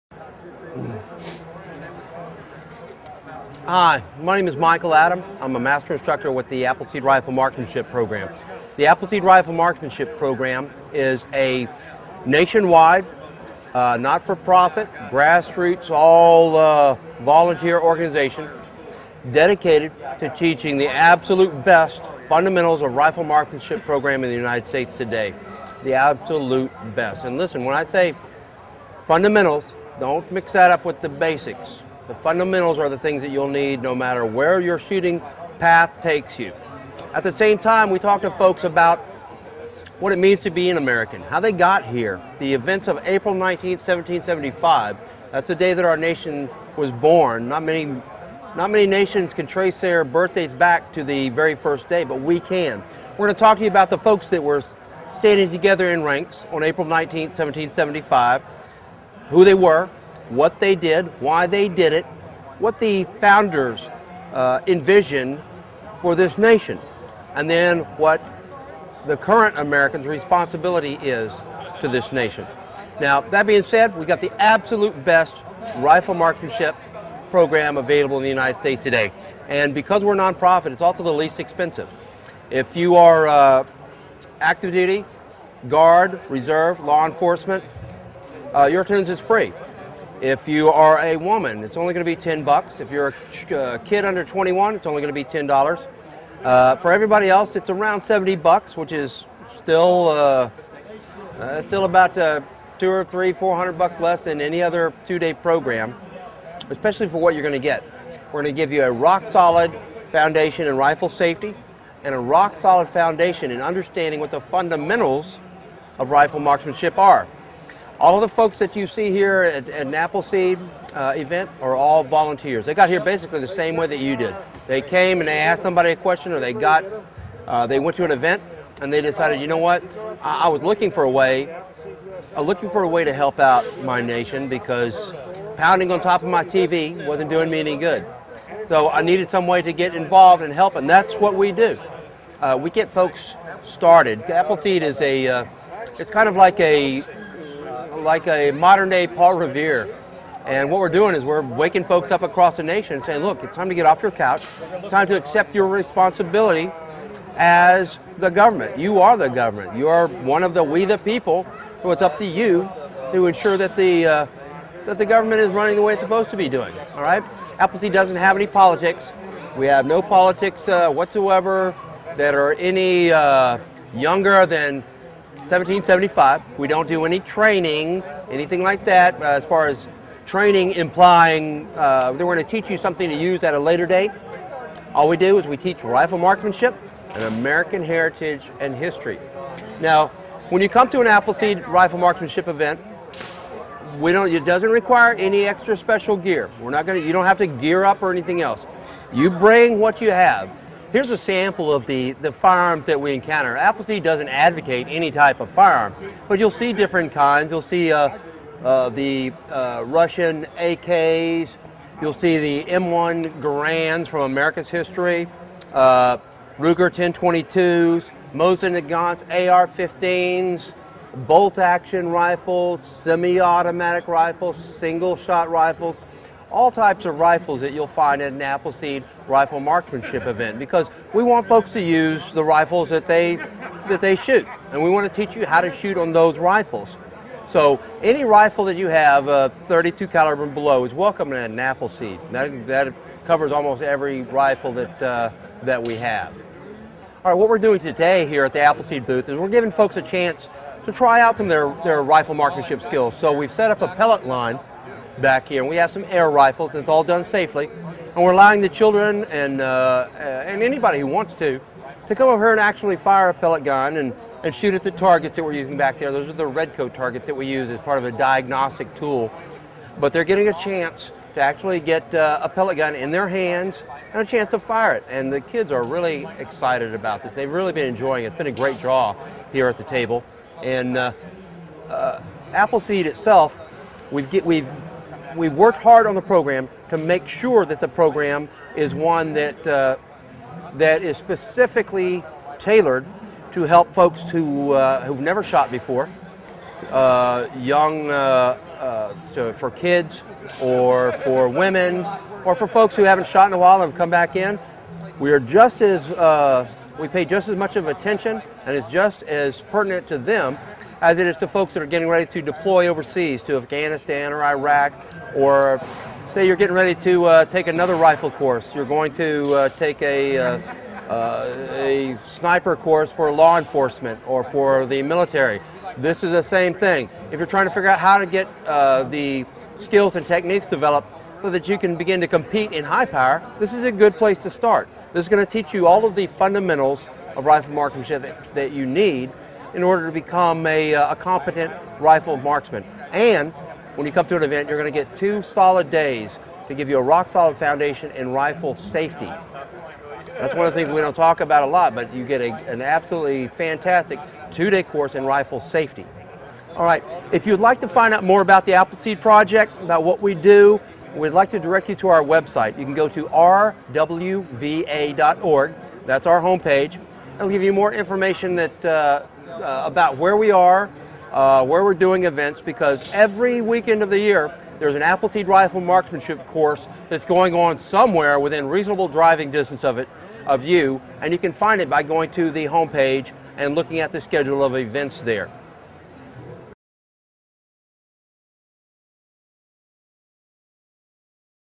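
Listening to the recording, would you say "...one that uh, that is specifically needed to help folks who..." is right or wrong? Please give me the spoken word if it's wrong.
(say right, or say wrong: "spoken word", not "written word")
wrong: "tailored", not "needed".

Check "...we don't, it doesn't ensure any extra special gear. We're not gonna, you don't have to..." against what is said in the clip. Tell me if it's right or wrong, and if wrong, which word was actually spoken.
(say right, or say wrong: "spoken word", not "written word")
wrong: "require", not "ensure".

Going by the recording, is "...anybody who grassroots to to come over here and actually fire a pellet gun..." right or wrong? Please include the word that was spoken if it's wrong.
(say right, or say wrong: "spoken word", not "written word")
wrong: "wants", not "grassroots".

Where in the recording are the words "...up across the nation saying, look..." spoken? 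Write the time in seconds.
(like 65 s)
152 s.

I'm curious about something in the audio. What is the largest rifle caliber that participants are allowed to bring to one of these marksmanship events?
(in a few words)
32 caliber.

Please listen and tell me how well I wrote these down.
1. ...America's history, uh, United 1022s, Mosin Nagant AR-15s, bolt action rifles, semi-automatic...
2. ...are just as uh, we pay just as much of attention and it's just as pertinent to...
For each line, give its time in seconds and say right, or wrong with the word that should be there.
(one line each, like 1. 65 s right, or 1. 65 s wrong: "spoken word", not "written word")
1. 214 s wrong: "Ruger", not "United"
2. 305 s right.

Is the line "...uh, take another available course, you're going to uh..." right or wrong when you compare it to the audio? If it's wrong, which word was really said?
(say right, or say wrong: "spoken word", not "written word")
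wrong: "rifle", not "available".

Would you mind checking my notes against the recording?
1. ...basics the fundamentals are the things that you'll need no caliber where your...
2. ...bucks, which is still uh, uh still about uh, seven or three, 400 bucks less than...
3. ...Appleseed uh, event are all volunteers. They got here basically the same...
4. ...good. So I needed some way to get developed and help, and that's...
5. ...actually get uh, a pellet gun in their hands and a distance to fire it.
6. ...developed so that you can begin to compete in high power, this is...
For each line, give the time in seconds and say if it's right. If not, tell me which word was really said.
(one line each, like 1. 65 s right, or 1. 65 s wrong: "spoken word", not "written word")
1. 31 s wrong: "matter", not "caliber"
2. 98 s wrong: "two", not "seven"
3. 119 s right
4. 137 s wrong: "involved", not "developed"
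5. 271 s wrong: "chance", not "distance"
6. 330 s right.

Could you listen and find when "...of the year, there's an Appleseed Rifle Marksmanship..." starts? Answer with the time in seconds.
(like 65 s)
374 s.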